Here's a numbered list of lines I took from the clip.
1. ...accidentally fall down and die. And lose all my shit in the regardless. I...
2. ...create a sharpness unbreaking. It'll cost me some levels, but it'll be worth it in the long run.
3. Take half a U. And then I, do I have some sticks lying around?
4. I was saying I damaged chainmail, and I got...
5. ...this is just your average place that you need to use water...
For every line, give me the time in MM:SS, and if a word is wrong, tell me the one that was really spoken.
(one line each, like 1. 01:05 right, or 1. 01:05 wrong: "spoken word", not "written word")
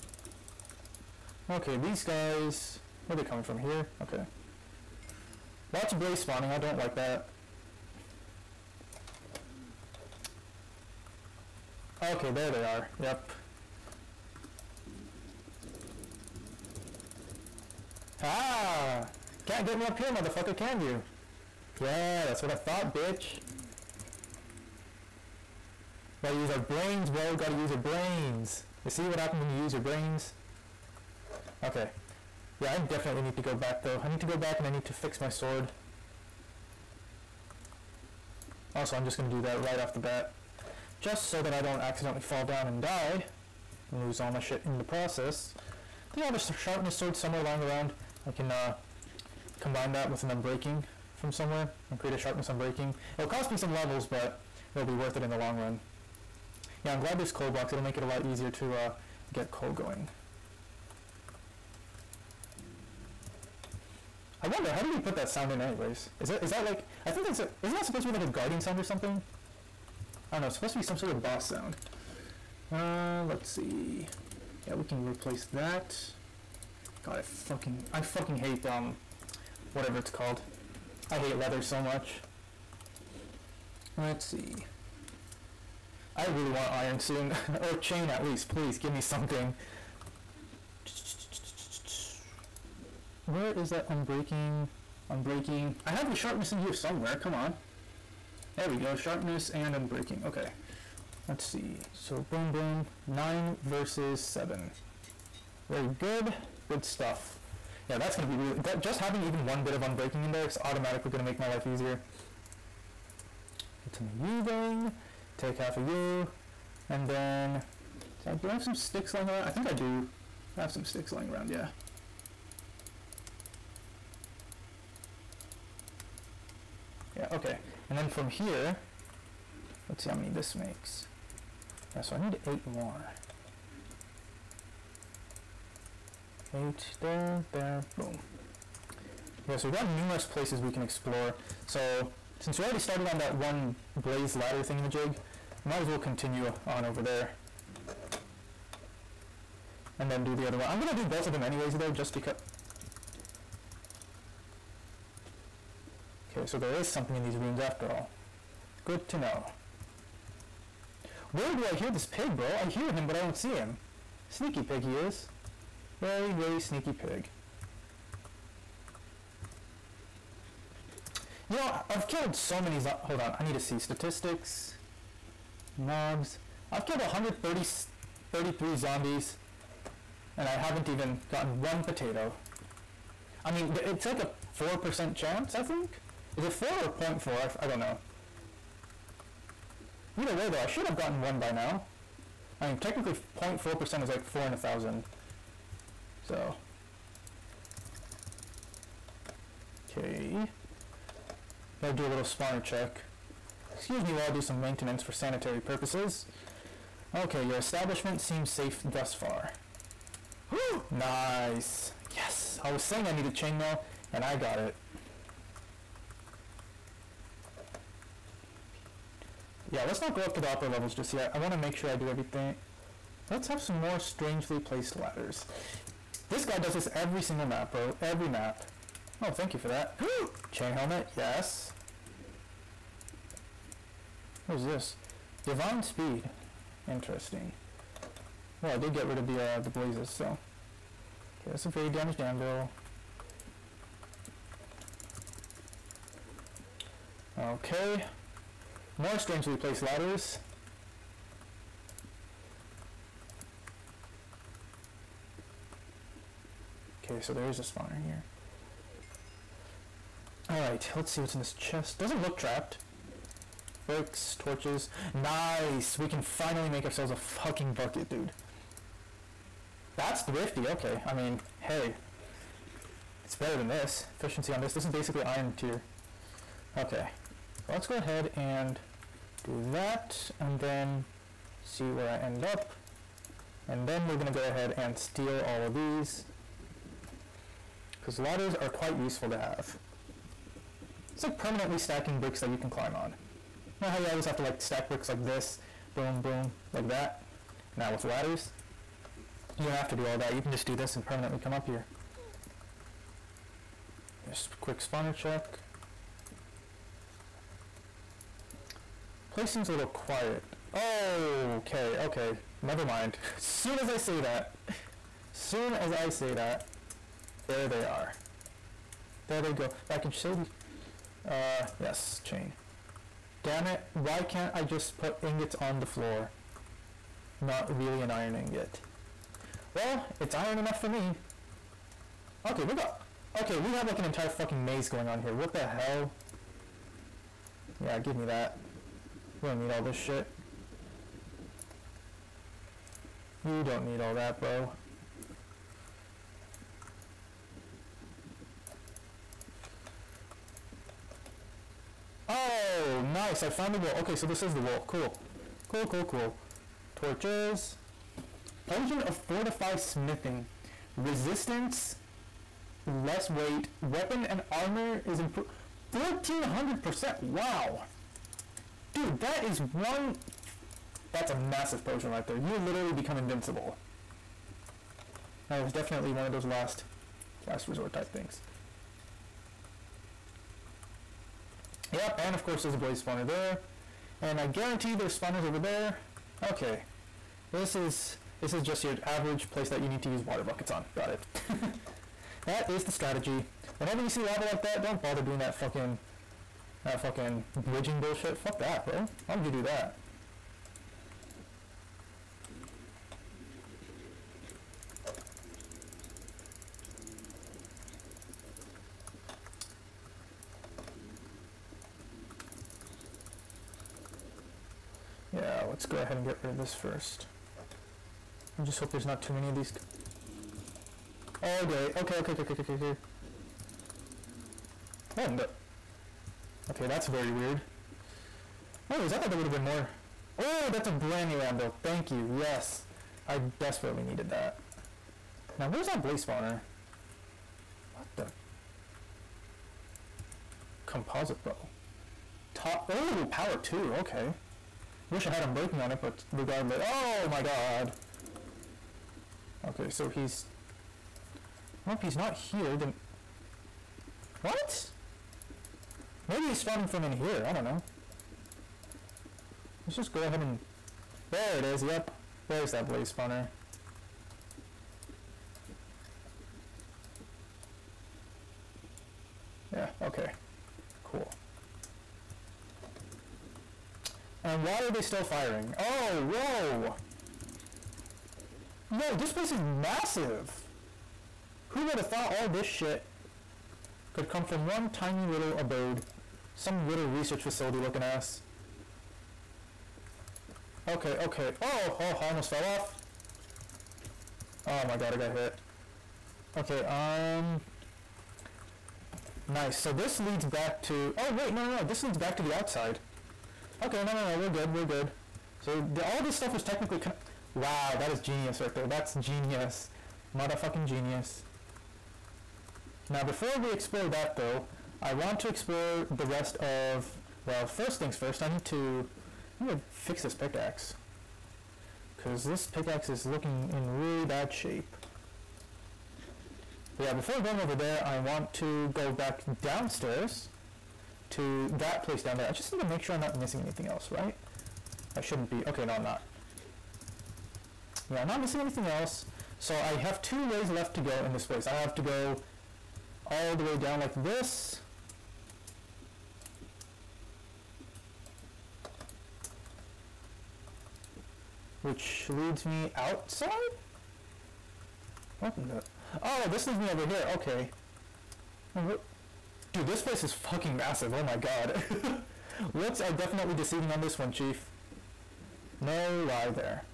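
1. 00:41 wrong: "process", not "regardless"
2. 00:51 right
3. 01:55 right
4. 03:32 wrong: "needed", not "damaged"
5. 06:28 right.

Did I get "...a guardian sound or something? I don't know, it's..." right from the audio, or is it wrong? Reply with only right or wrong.
right.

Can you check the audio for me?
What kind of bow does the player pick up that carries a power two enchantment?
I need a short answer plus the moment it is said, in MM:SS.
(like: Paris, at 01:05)
Composite bow, at 07:20.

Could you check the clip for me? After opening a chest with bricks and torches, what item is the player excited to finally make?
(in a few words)
Bucket.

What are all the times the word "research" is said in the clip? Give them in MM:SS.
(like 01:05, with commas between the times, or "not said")
08:07.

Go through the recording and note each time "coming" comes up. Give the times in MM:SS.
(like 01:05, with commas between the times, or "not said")
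00:03.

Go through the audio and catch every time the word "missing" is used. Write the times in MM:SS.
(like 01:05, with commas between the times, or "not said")
08:53, 08:58.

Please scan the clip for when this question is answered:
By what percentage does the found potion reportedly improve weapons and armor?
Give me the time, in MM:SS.
06:05.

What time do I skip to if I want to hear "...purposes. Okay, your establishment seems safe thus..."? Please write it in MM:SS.
03:25.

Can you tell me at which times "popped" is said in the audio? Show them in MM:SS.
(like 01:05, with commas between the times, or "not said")
not said.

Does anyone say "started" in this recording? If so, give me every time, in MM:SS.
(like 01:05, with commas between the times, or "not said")
02:22.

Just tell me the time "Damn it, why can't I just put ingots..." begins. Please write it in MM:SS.
05:23.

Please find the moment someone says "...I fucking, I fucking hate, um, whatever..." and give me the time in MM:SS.
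01:17.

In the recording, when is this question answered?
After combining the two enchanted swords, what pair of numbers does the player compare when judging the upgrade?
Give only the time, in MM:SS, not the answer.
01:43.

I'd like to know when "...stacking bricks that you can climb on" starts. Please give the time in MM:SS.
04:51.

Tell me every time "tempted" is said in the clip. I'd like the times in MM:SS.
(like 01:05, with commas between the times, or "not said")
not said.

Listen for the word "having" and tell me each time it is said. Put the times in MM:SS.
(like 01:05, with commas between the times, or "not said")
01:48.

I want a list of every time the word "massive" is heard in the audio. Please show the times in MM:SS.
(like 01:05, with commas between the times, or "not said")
06:11, 07:59, 09:20.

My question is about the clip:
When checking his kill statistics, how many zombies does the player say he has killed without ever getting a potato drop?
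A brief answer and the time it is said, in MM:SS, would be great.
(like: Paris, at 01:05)
133, at 02:56.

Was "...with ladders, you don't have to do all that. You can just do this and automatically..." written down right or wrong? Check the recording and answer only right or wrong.
wrong.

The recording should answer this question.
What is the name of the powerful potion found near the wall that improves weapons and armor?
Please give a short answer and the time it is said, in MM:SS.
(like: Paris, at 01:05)
Potion of Fortify Smithing, at 05:58.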